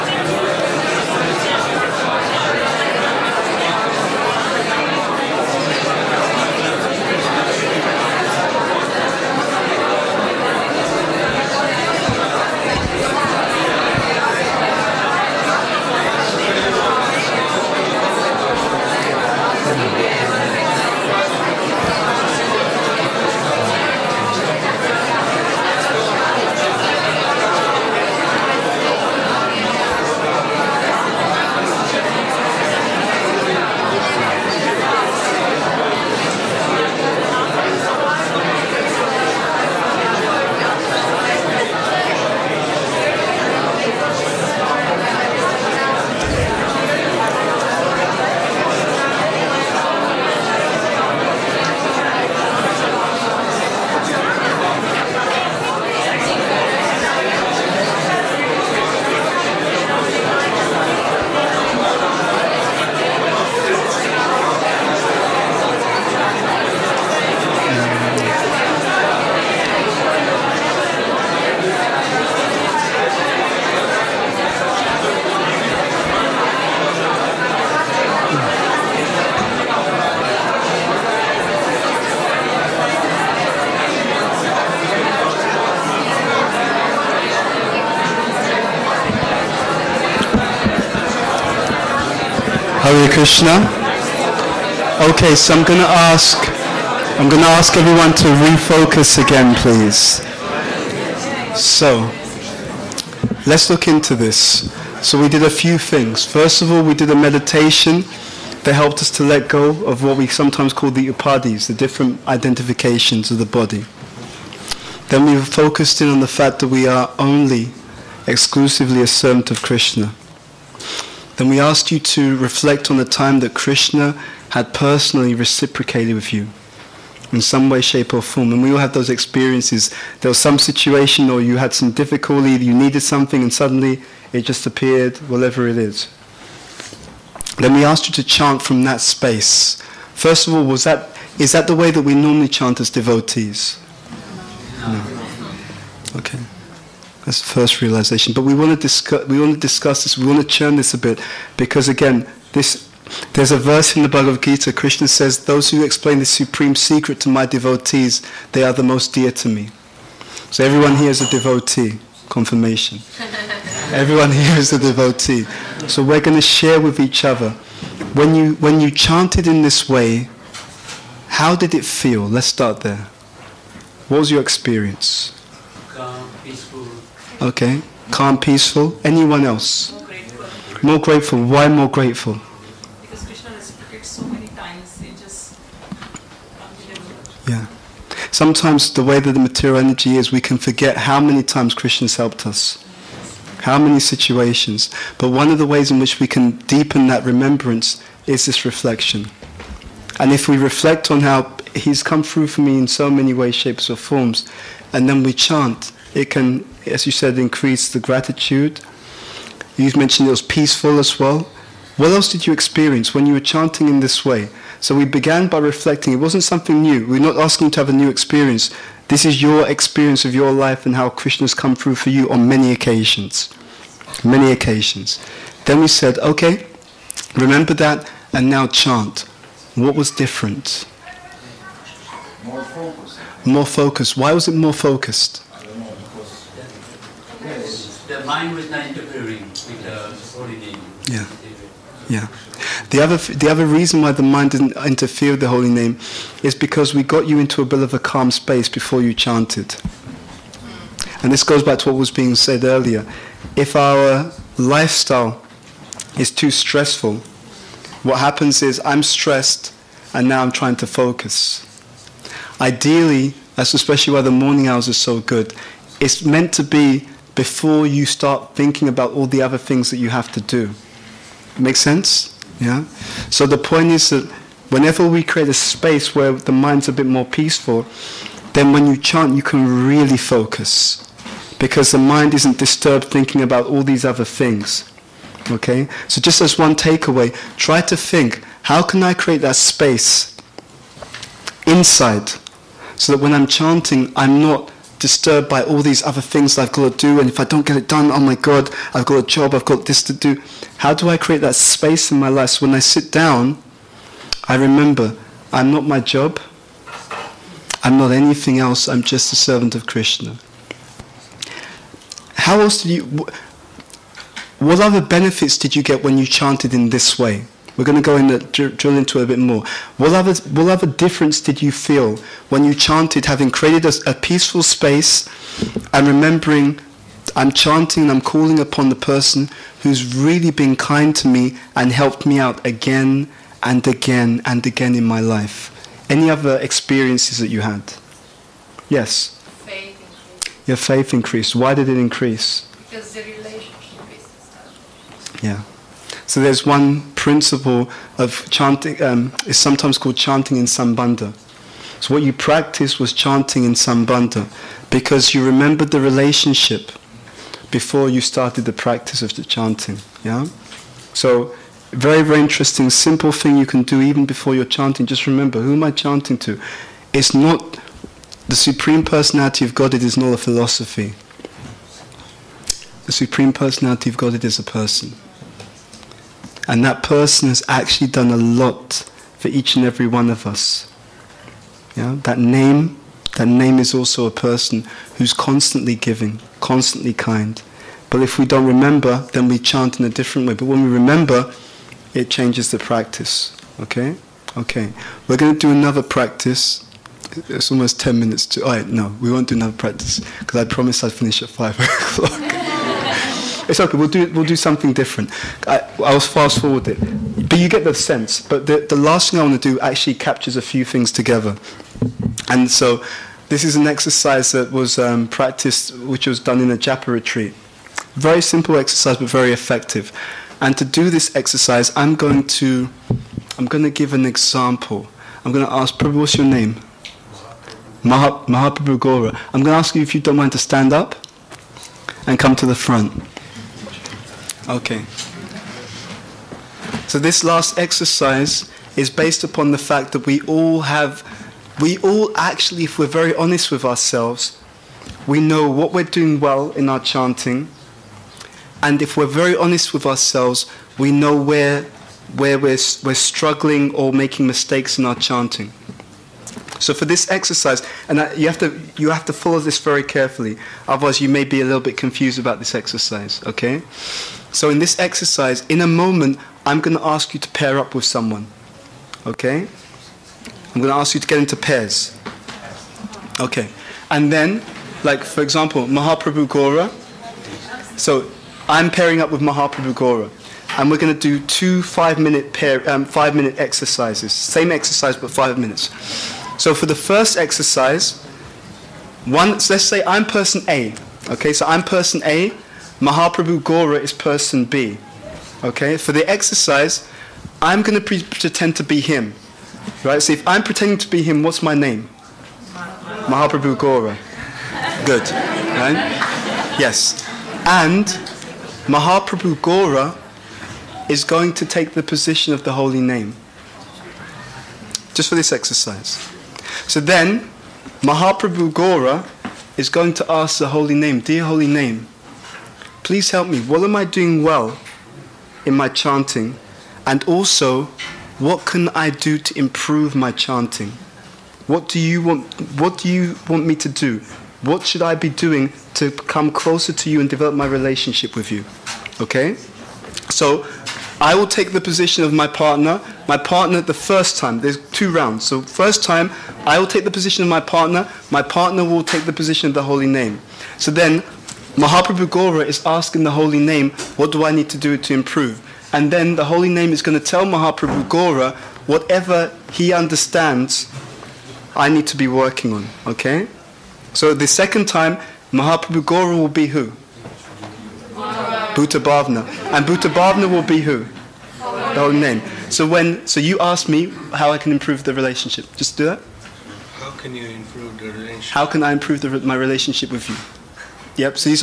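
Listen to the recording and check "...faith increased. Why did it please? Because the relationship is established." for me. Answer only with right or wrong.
wrong.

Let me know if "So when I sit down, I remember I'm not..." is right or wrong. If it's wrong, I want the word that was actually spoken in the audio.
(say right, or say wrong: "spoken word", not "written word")
right.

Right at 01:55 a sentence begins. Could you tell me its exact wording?
Then we focused in on the fact that we are only exclusively a servant of Krishna.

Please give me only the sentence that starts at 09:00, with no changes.
So, I will take the position of my partner.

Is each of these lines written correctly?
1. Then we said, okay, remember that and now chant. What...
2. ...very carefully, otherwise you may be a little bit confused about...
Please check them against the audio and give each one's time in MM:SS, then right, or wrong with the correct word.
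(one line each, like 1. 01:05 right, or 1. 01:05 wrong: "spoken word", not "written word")
1. 03:45 right
2. 07:39 right.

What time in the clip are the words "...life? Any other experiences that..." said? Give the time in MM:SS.
05:35.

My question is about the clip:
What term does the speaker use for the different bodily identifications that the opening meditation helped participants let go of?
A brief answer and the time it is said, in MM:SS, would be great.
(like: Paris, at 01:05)
upadhis, at 01:51.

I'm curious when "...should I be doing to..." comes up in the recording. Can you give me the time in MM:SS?
08:54.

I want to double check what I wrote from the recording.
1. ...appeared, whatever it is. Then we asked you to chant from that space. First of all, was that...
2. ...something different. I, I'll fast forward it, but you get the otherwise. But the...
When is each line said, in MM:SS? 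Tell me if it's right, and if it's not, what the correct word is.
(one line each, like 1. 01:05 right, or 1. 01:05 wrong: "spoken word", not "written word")
1. 02:14 right
2. 06:44 wrong: "sense", not "otherwise".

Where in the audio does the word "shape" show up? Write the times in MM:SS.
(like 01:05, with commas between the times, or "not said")
02:07, 03:23.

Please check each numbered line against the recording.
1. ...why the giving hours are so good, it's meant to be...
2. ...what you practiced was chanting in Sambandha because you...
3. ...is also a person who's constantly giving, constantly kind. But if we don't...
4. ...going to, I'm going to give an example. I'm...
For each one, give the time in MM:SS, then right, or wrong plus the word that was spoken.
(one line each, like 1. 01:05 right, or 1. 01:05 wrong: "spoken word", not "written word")
1. 04:24 wrong: "morning", not "giving"
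2. 05:52 right
3. 06:23 right
4. 07:02 right.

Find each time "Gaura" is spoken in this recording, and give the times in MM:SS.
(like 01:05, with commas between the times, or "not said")
09:12, 09:18, 09:26.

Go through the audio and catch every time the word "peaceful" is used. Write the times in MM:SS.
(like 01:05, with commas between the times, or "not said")
02:58, 03:30, 04:37, 05:24.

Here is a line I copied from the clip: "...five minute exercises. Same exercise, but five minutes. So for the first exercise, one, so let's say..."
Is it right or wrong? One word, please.
right.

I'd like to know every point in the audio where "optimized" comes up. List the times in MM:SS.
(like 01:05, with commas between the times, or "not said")
not said.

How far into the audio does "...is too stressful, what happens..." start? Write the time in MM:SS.
04:16.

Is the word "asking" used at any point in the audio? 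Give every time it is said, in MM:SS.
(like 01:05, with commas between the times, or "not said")
03:37, 09:12.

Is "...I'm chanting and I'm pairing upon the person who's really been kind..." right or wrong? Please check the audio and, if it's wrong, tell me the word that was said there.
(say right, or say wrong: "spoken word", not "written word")
wrong: "calling", not "pairing".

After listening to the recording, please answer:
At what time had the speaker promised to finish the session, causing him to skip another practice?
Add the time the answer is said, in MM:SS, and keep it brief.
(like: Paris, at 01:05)
5 o'clock, at 06:41.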